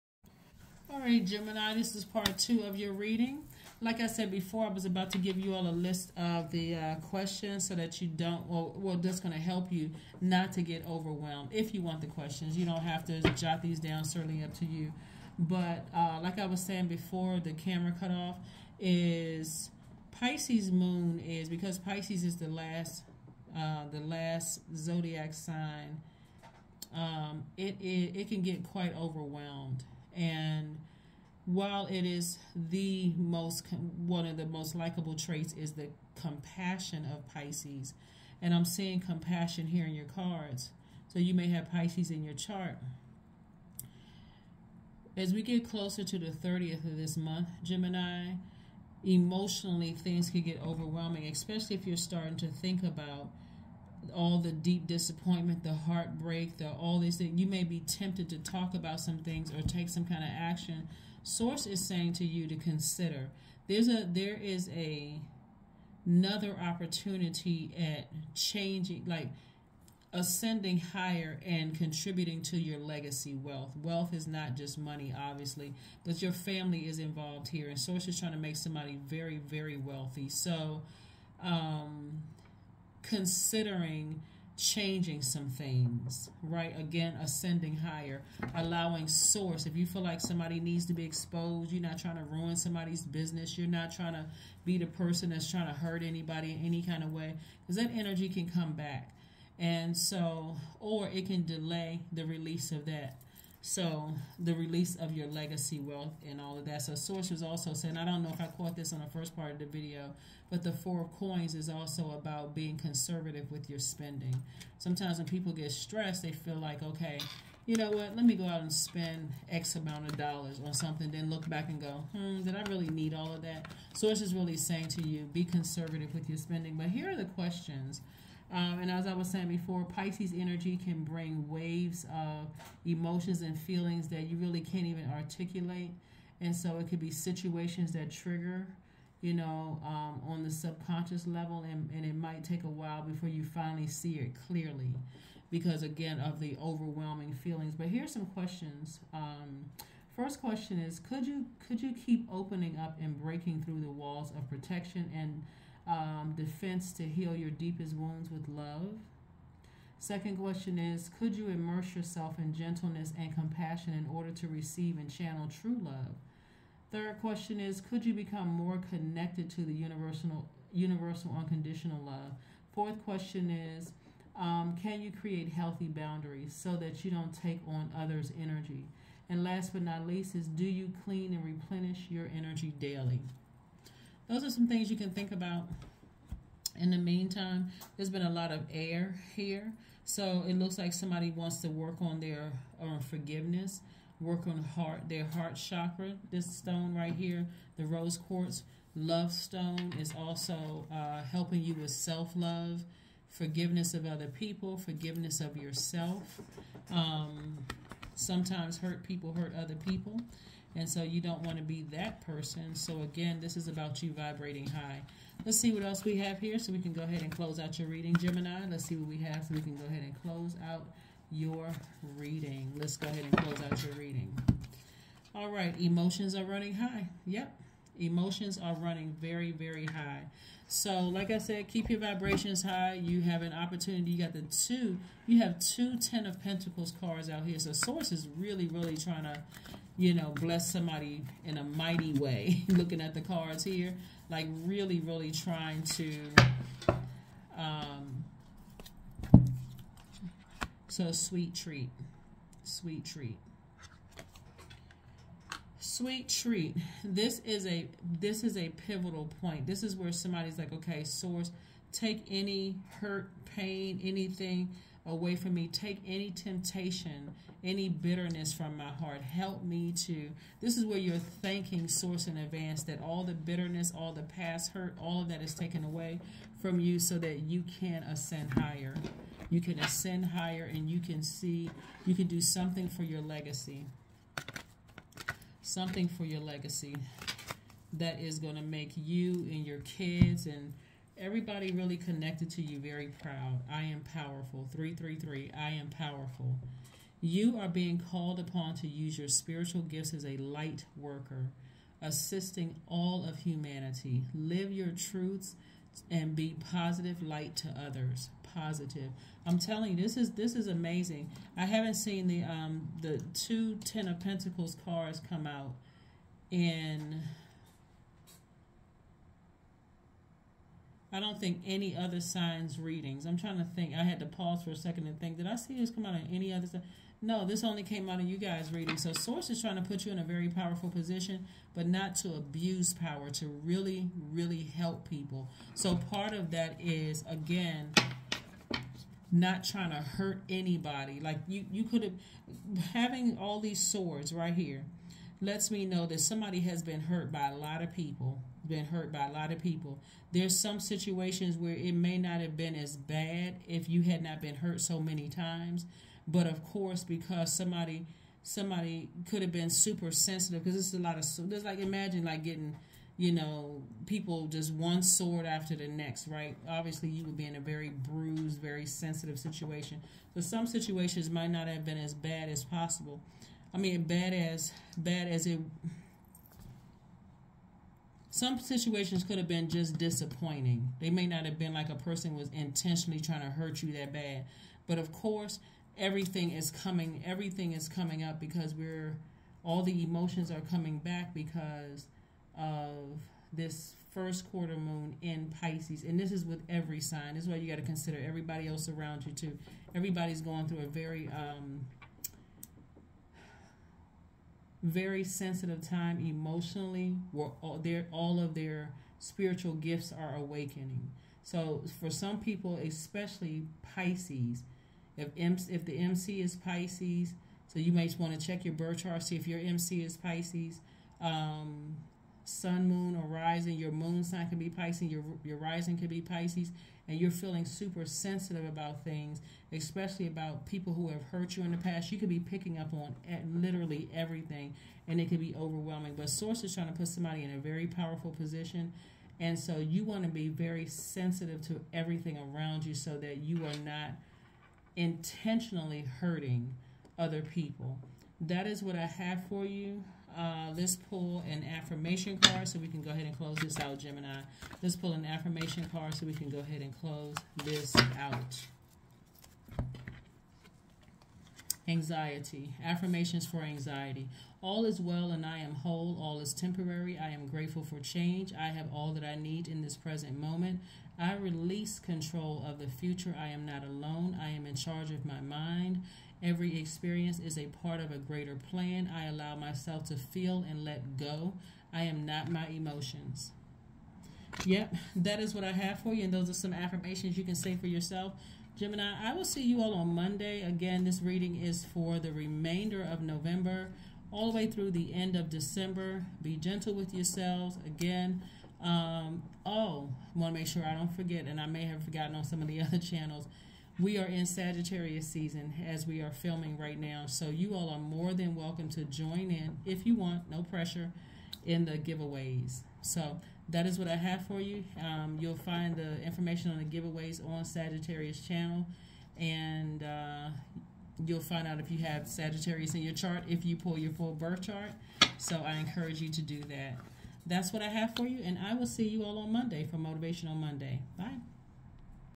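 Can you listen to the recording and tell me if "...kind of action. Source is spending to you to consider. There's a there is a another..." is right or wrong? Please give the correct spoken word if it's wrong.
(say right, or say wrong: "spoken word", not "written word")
wrong: "saying", not "spending".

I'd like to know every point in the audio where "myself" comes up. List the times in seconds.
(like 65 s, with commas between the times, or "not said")
479 s.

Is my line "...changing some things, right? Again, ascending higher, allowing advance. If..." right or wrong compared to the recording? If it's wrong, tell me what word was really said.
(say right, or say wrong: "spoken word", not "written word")
wrong: "source", not "advance".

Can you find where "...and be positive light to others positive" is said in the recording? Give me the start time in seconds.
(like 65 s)
306 s.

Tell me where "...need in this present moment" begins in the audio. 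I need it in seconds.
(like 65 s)
469 s.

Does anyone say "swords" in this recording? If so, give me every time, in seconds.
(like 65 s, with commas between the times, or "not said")
343 s, 365 s.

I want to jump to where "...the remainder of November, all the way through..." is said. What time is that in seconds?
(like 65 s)
492 s.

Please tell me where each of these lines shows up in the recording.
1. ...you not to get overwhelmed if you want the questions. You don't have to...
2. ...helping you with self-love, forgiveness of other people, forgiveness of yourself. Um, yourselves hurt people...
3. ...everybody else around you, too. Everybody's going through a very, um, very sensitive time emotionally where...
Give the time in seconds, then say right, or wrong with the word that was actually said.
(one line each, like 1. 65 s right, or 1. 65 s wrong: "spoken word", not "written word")
1. 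9 s right
2. 201 s wrong: "sometimes", not "yourselves"
3. 398 s right.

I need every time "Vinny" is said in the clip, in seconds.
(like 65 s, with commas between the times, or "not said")
not said.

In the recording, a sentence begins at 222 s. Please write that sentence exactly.
Let's go ahead and close out your reading.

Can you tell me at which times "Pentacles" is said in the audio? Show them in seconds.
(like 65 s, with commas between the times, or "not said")
236 s, 314 s.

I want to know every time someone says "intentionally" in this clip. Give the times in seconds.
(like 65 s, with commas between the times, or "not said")
382 s, 444 s.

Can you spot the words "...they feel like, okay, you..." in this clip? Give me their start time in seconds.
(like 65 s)
116 s.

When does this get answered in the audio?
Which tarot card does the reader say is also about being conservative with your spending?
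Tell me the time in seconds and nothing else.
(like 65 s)
110 s.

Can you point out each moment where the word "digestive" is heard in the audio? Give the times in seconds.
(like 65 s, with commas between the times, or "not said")
not said.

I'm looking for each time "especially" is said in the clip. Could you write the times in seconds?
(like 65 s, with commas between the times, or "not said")
51 s, 412 s, 429 s.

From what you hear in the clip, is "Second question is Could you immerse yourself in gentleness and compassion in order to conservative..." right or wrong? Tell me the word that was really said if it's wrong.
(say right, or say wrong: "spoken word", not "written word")
wrong: "receive", not "conservative".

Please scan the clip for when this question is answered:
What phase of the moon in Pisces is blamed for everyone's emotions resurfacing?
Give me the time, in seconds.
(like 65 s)
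394 s.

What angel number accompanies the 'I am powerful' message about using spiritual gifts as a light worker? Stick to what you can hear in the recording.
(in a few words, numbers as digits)
333.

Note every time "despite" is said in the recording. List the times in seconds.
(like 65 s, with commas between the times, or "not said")
not said.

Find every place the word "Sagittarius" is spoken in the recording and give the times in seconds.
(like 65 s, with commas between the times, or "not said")
504 s, 517 s, 522 s.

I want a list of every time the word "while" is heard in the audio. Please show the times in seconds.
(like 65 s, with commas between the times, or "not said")
31 s, 142 s.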